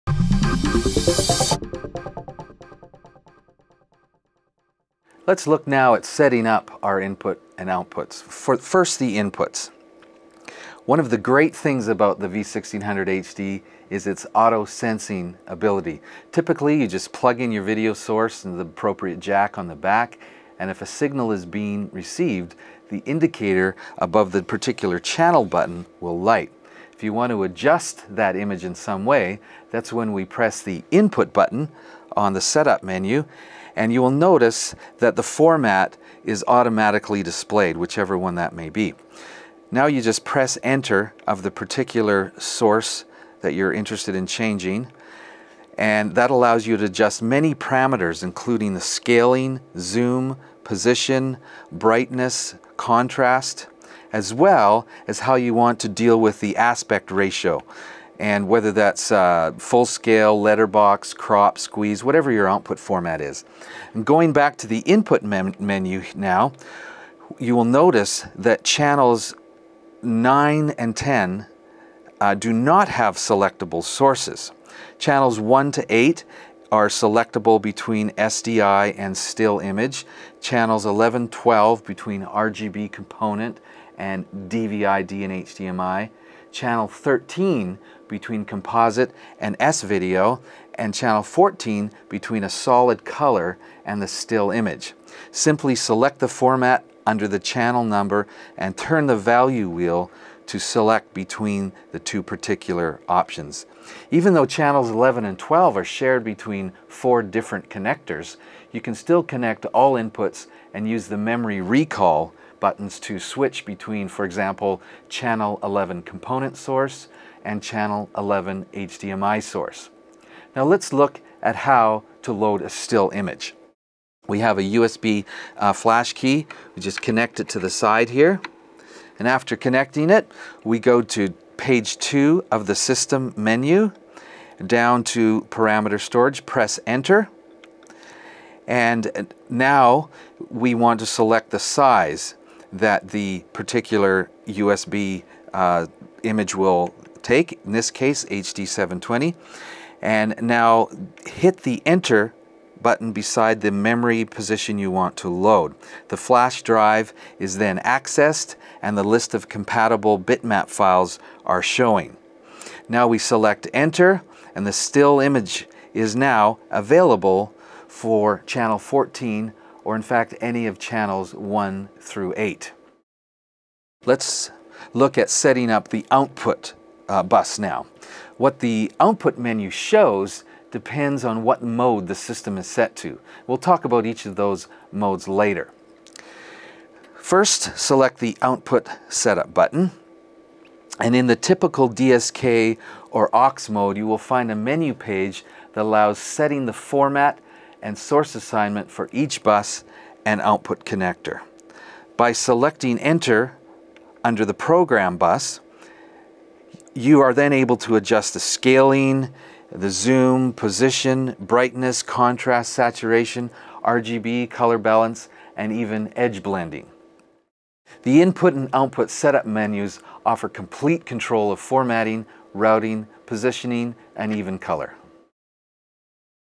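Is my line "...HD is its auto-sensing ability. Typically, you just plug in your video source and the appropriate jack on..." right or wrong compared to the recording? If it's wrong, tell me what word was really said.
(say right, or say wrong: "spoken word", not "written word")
right.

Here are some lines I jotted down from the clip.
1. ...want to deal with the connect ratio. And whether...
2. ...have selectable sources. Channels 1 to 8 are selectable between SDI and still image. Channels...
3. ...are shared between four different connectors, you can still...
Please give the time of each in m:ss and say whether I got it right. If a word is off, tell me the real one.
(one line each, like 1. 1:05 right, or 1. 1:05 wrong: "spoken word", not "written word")
1. 0:55 wrong: "aspect", not "connect"
2. 1:12 right
3. 1:45 right.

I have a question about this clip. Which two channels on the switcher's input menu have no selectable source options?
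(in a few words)
9 and 10.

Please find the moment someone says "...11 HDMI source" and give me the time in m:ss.
1:58.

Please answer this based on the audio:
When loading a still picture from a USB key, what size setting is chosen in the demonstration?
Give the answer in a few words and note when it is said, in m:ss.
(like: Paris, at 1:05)
HD720, at 2:28.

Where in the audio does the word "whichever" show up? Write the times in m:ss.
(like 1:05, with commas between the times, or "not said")
0:37.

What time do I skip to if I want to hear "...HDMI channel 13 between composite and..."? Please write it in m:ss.
1:25.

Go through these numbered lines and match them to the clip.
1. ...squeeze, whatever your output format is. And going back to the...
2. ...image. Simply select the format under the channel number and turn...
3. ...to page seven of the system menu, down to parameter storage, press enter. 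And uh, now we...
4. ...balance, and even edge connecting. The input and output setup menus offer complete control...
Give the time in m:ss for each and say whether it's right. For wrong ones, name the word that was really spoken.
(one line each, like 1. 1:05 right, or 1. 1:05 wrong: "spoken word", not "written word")
1. 1:01 right
2. 1:34 right
3. 2:11 wrong: "two", not "seven"
4. 3:34 wrong: "blending", not "connecting".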